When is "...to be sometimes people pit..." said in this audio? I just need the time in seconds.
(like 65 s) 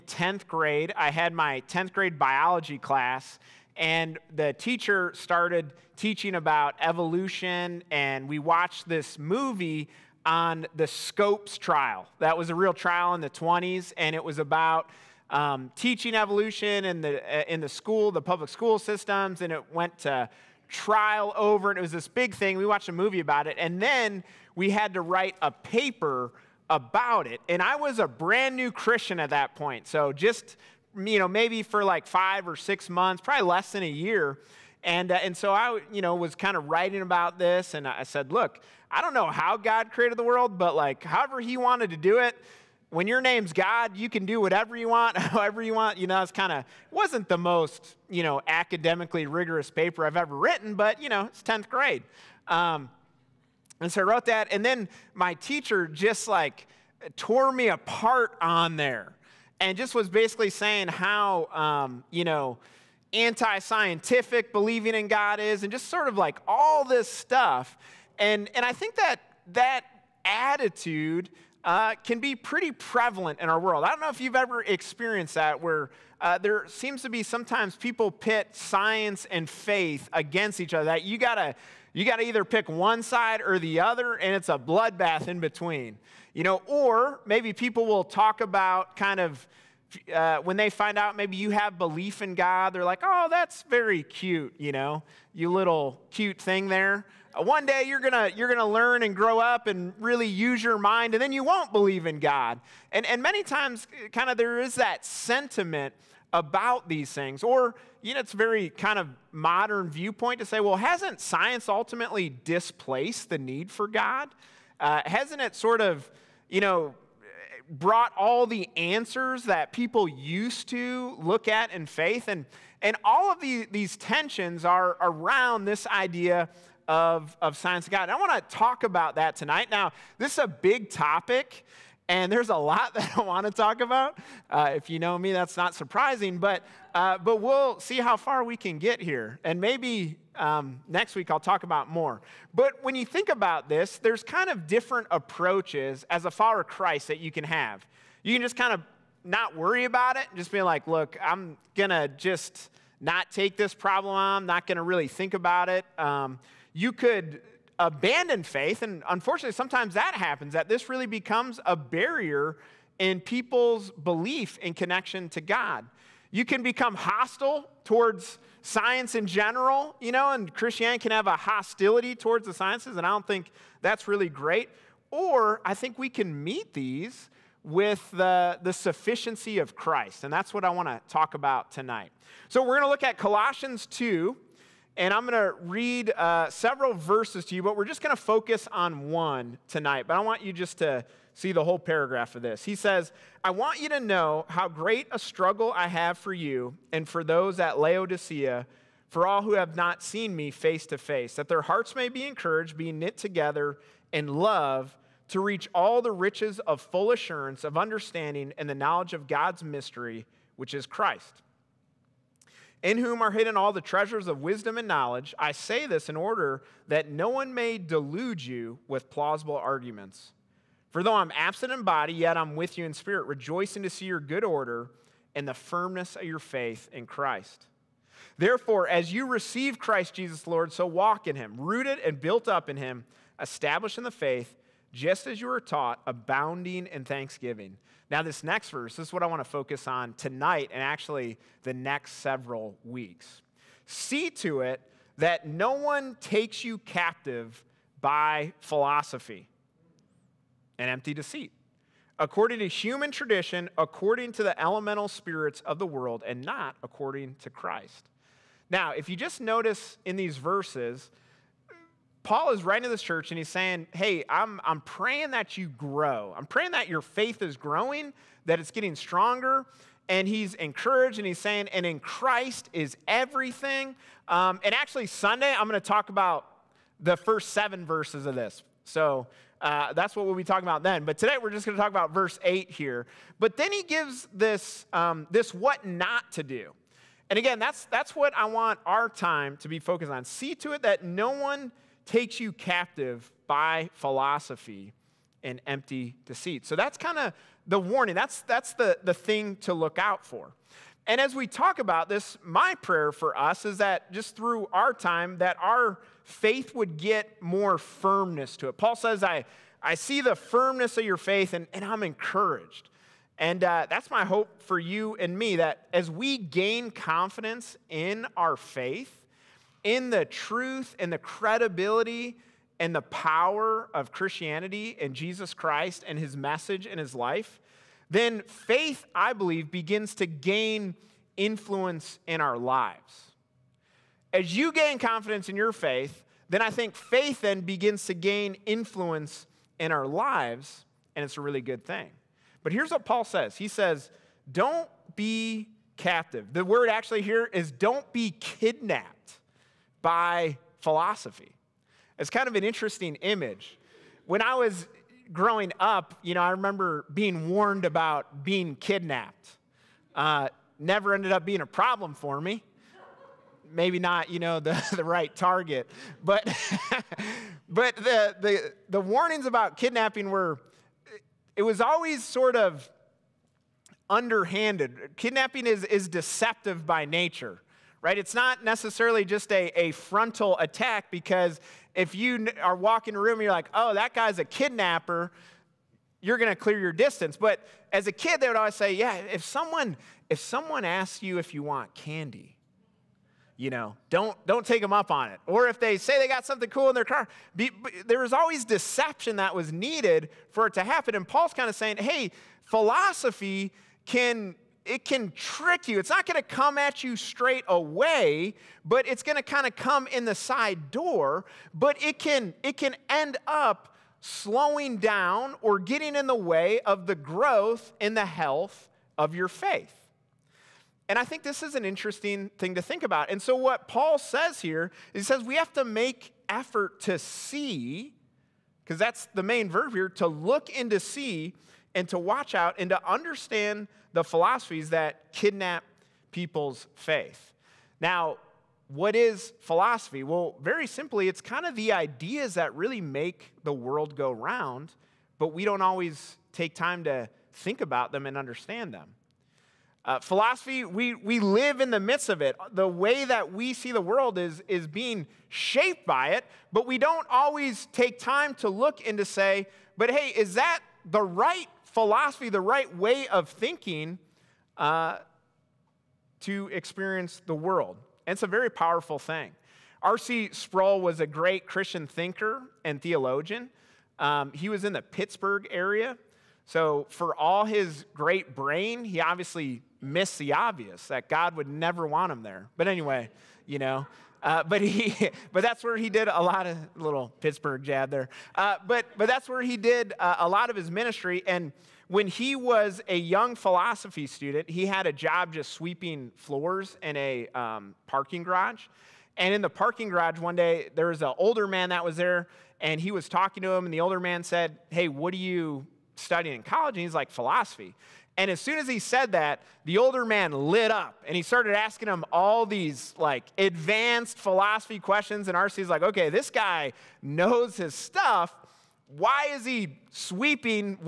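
77 s.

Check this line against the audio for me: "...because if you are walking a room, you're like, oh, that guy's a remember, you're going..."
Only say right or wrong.
wrong.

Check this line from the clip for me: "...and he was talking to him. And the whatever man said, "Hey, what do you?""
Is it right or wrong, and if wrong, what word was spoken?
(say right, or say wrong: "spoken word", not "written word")
wrong: "older", not "whatever".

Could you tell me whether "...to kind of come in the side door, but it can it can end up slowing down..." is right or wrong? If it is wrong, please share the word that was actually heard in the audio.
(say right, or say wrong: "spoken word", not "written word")
right.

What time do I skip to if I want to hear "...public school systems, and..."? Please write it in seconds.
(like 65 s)
18 s.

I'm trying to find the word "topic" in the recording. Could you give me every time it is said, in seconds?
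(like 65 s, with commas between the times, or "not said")
130 s.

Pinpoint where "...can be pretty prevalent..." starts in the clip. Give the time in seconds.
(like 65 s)
72 s.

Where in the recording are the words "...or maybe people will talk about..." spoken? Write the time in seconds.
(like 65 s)
86 s.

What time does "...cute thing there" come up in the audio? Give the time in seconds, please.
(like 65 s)
96 s.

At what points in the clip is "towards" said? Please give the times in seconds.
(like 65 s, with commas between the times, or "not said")
167 s, 172 s.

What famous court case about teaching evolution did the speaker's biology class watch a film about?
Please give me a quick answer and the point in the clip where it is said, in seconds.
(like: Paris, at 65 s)
Scopes trial, at 10 s.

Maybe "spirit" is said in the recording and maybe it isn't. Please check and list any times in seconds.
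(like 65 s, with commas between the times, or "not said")
222 s, 255 s.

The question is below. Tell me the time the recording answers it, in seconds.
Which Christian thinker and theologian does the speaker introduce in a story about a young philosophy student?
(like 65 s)
470 s.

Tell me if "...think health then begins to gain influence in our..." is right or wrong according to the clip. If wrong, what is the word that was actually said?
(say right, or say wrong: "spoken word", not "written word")
wrong: "faith", not "health".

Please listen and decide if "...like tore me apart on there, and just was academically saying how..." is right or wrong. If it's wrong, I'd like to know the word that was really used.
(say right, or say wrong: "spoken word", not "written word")
wrong: "basically", not "academically".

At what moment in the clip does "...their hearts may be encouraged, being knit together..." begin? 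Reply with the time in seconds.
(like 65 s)
201 s.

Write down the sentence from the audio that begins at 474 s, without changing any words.
Um, he was in the Pittsburgh area.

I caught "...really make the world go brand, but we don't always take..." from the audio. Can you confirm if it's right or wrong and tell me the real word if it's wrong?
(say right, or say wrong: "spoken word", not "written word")
wrong: "round", not "brand".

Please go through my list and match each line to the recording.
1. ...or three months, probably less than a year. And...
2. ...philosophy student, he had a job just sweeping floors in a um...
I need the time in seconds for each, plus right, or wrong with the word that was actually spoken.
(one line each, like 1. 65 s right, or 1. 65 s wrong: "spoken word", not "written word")
1. 32 s wrong: "six", not "three"
2. 493 s right.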